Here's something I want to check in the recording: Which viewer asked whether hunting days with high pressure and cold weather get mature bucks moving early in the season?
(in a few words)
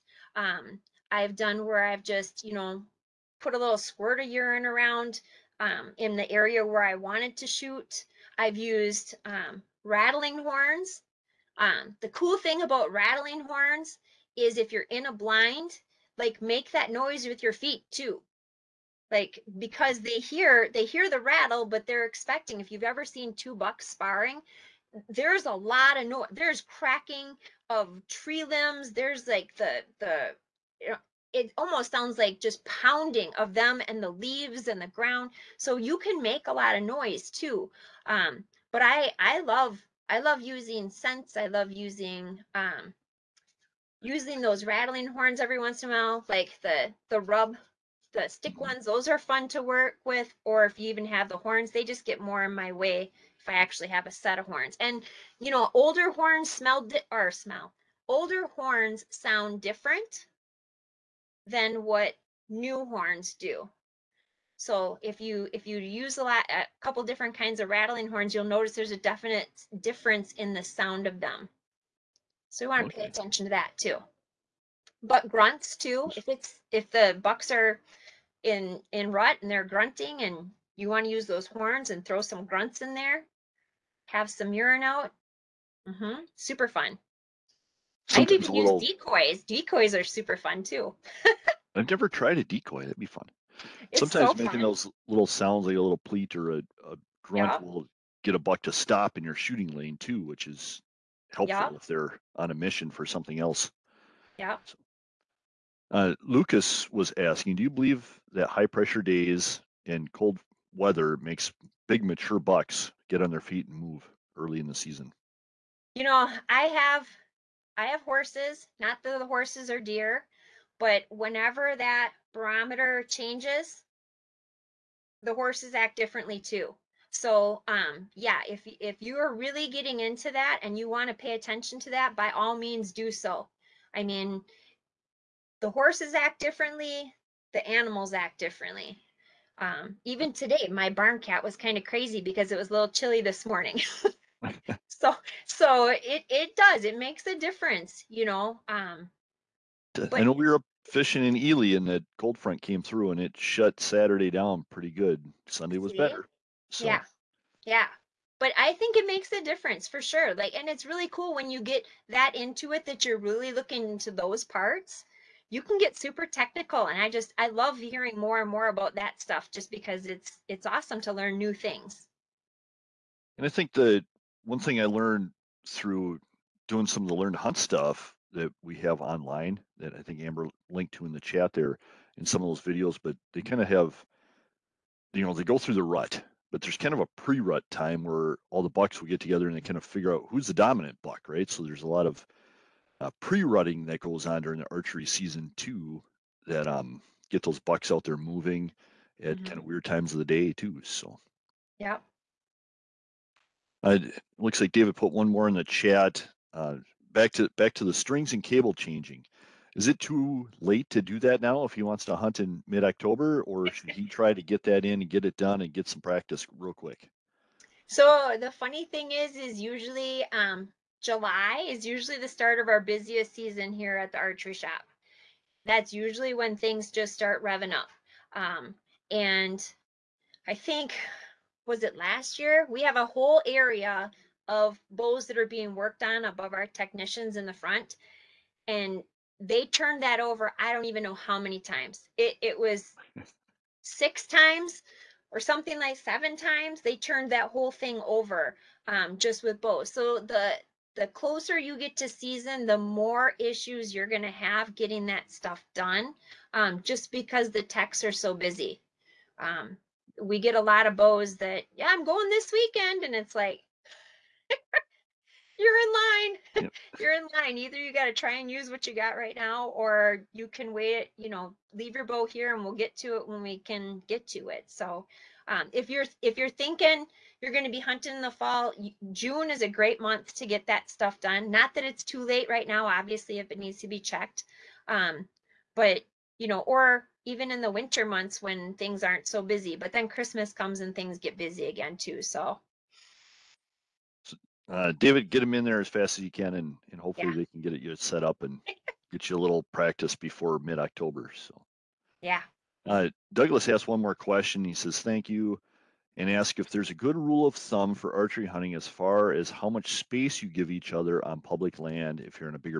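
Lucas.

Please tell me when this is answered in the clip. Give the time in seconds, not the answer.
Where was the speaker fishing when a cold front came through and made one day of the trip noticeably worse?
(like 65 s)
151 s.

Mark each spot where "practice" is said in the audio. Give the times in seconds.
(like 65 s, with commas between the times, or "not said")
216 s, 299 s.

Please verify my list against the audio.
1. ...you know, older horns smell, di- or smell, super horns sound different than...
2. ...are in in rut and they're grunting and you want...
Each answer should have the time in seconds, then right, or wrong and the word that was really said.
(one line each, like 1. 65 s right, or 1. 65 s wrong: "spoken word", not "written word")
1. 55 s wrong: "older", not "super"
2. 77 s right.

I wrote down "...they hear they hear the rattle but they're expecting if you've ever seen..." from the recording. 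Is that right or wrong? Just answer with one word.
right.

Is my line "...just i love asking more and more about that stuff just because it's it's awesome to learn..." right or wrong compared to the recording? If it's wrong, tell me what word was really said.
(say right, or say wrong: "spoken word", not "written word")
wrong: "hearing", not "asking".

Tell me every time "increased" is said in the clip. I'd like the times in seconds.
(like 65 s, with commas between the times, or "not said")
not said.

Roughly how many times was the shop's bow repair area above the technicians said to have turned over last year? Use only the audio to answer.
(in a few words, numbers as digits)
6.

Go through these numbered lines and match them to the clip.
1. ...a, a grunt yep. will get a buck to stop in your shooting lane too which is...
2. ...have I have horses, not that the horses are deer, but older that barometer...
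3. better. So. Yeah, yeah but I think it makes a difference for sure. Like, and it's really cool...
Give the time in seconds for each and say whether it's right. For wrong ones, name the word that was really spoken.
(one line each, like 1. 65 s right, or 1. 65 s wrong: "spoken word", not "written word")
1. 96 s right
2. 116 s wrong: "whenever", not "older"
3. 155 s right.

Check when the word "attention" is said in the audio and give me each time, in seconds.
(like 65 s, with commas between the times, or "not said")
73 s, 131 s.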